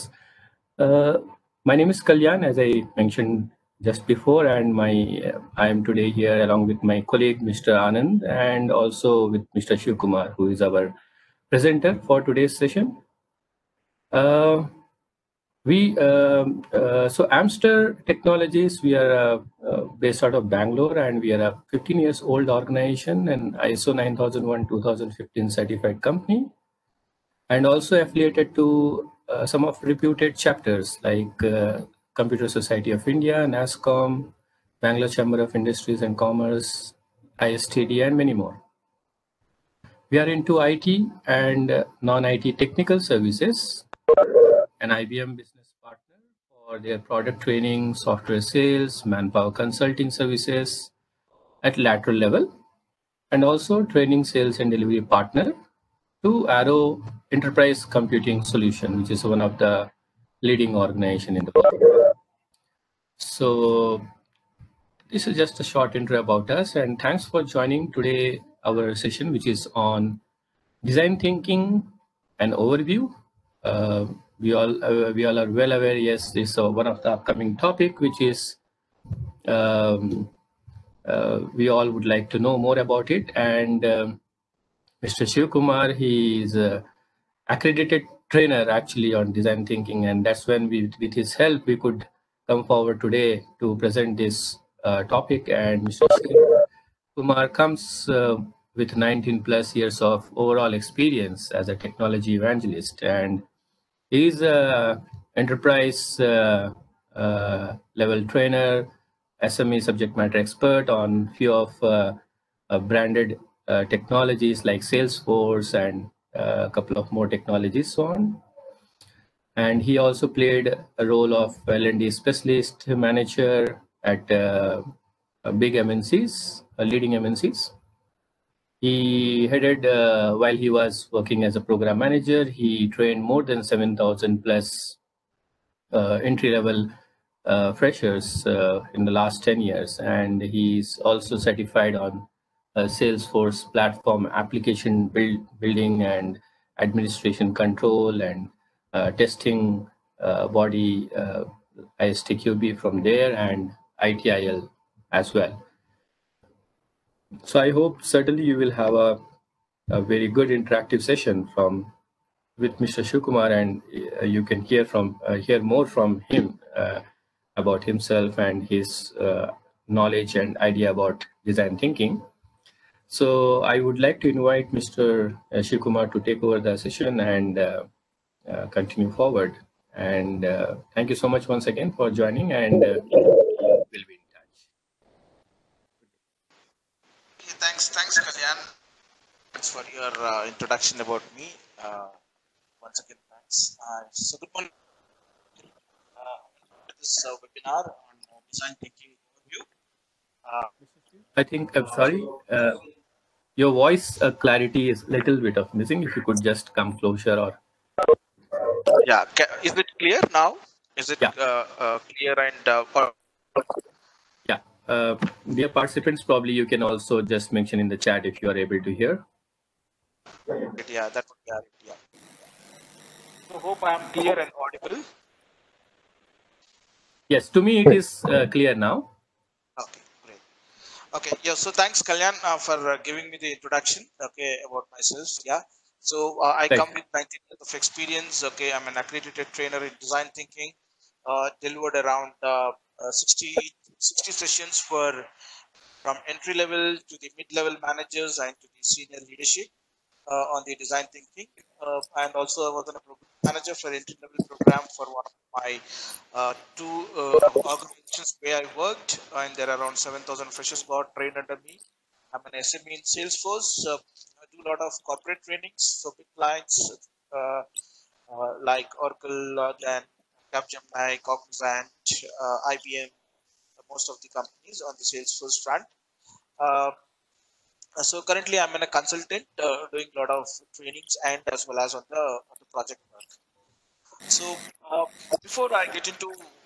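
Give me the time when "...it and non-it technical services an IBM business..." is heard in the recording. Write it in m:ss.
0:40.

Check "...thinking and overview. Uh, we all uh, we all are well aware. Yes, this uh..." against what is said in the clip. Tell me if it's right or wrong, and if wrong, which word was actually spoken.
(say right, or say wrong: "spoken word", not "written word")
right.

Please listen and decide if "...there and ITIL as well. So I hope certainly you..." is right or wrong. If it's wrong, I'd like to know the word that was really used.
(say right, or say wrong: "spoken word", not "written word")
right.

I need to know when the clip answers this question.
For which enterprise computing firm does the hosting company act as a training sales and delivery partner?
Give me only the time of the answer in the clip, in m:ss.
0:56.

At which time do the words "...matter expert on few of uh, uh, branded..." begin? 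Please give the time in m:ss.
1:50.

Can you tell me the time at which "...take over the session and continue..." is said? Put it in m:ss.
2:56.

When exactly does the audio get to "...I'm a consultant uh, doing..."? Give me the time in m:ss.
4:38.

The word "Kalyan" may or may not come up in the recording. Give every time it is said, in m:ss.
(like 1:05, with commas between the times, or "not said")
0:02, 3:08, 3:52.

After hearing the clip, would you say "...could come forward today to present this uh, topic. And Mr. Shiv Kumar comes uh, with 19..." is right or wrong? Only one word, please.
right.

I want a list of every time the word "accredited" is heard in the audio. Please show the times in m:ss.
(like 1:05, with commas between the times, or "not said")
1:27, 3:58.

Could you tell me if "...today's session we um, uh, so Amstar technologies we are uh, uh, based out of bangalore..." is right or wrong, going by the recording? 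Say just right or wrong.
right.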